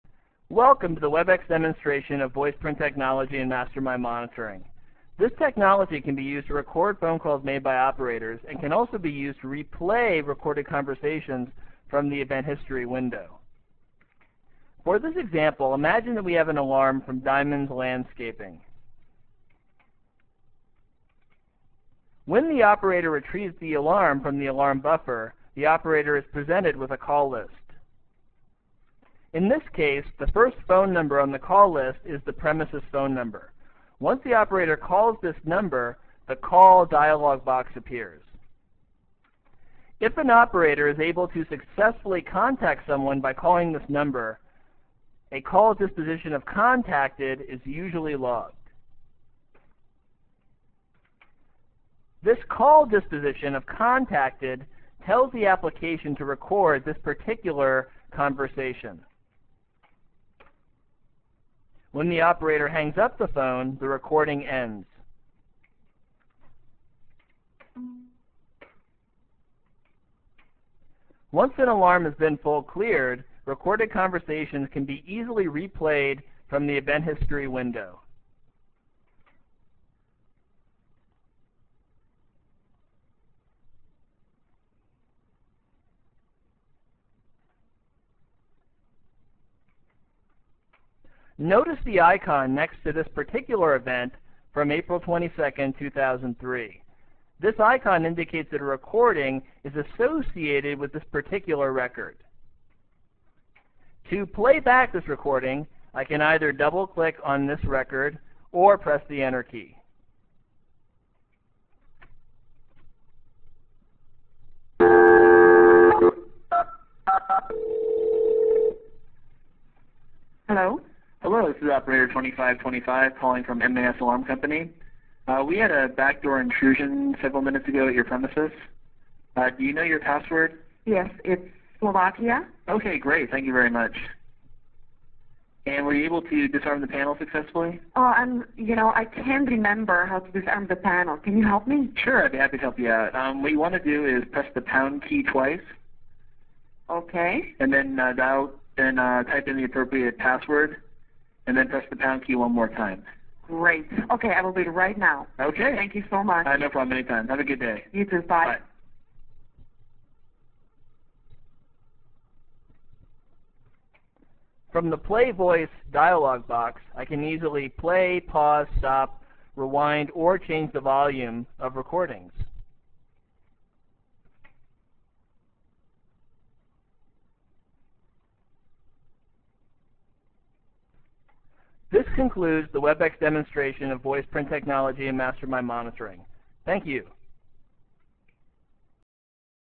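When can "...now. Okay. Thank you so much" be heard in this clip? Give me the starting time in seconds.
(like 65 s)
154 s.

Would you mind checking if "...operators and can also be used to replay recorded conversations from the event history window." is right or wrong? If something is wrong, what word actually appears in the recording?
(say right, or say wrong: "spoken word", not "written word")
right.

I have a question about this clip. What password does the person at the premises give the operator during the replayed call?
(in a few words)
Slovakia.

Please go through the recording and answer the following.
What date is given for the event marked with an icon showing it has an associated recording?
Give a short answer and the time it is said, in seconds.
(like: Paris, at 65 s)
April 22, 2003, at 94 s.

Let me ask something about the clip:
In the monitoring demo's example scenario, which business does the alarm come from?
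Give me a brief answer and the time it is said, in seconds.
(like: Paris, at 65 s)
Diamonds Landscaping, at 17 s.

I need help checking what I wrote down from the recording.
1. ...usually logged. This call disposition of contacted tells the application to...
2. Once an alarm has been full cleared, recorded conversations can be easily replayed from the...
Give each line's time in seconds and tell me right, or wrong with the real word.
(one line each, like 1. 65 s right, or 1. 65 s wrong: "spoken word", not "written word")
1. 47 s right
2. 71 s right.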